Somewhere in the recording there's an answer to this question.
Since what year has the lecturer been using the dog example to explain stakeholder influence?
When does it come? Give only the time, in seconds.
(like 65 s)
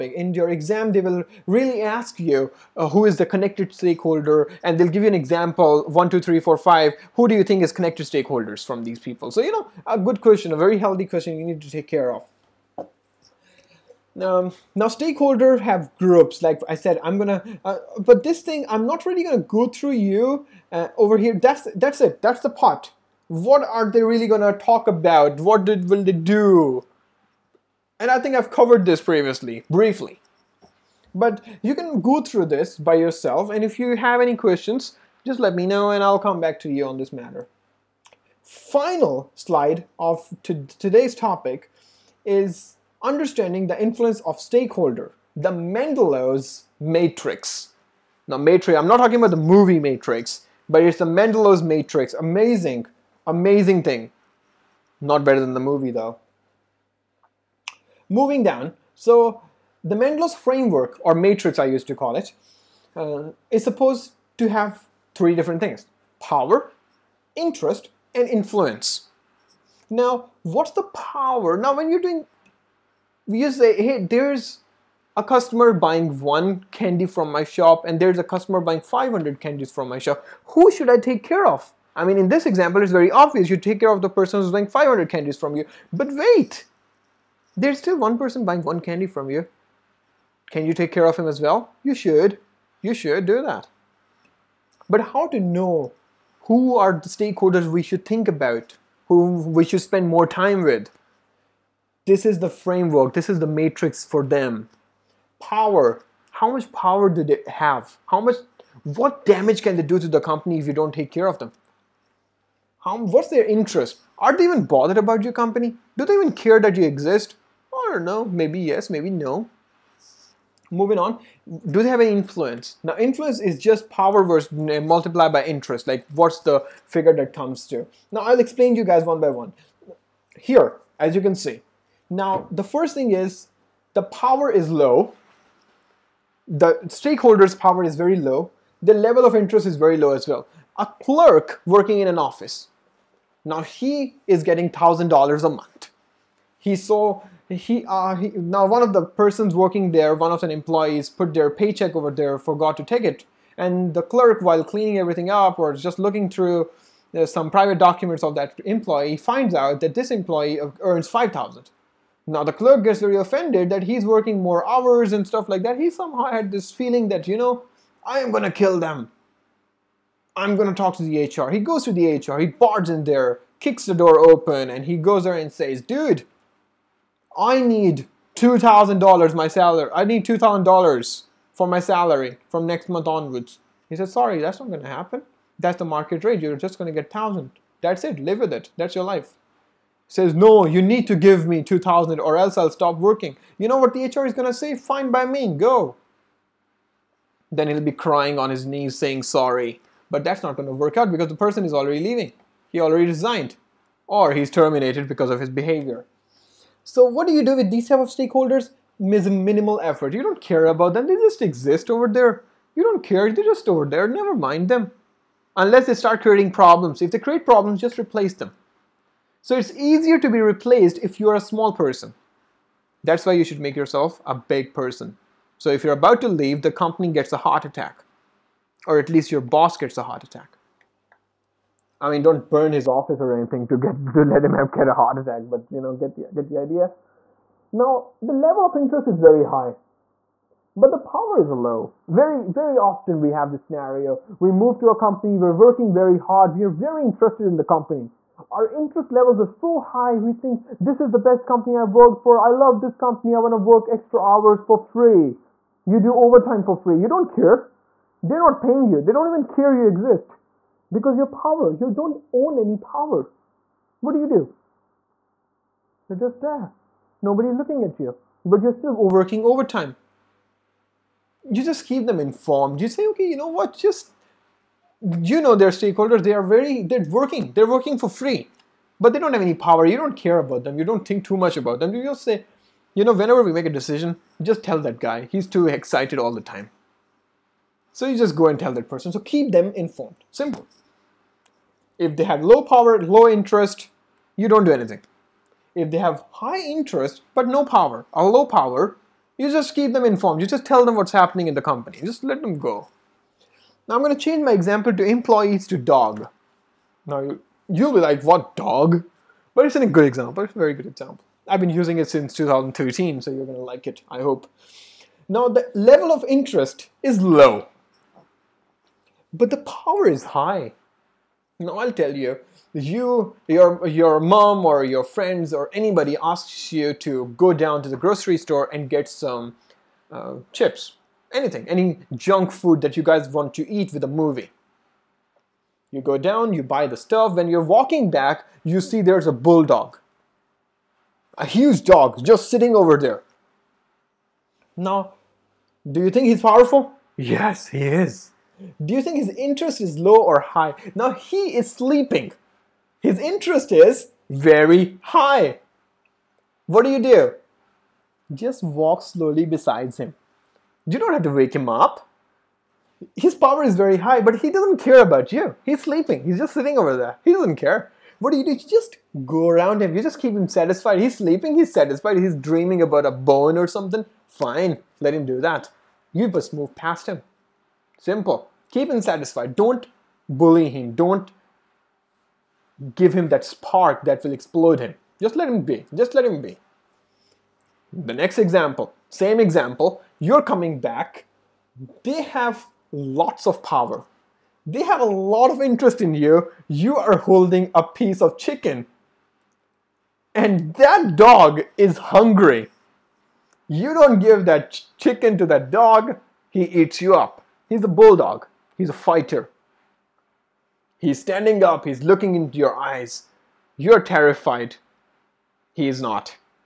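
312 s.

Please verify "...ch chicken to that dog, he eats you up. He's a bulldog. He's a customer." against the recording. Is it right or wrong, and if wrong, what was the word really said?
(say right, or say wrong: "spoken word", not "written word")
wrong: "fighter", not "customer".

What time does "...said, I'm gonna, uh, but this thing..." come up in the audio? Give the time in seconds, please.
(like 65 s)
16 s.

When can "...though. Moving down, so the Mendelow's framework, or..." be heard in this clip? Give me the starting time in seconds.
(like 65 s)
55 s.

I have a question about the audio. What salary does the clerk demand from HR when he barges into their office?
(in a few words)
$2,000.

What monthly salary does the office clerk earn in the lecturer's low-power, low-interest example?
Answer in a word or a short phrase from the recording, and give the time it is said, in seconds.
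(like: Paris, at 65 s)
$1,000, at 144 s.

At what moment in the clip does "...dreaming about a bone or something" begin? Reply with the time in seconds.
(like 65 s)
372 s.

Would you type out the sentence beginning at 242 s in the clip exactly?
Very, very often we have this scenario: we move to a company, we're working very hard, we're very interested in the company.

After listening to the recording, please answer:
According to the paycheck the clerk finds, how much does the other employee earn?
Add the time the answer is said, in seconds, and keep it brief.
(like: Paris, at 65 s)
5000, at 161 s.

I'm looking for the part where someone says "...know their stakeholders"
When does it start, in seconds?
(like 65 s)
275 s.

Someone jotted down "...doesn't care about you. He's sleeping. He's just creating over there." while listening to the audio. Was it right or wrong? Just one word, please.
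wrong.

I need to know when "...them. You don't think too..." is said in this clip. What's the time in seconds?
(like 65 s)
280 s.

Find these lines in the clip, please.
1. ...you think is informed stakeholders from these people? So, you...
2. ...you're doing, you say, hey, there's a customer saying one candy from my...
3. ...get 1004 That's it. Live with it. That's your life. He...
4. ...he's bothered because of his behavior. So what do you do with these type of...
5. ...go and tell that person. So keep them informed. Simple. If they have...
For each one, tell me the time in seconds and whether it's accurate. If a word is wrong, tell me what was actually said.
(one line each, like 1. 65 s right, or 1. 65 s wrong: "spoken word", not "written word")
1. 7 s wrong: "connected", not "informed"
2. 71 s wrong: "buying", not "saying"
3. 187 s wrong: "1000", not "1004"
4. 204 s wrong: "terminated", not "bothered"
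5. 288 s right.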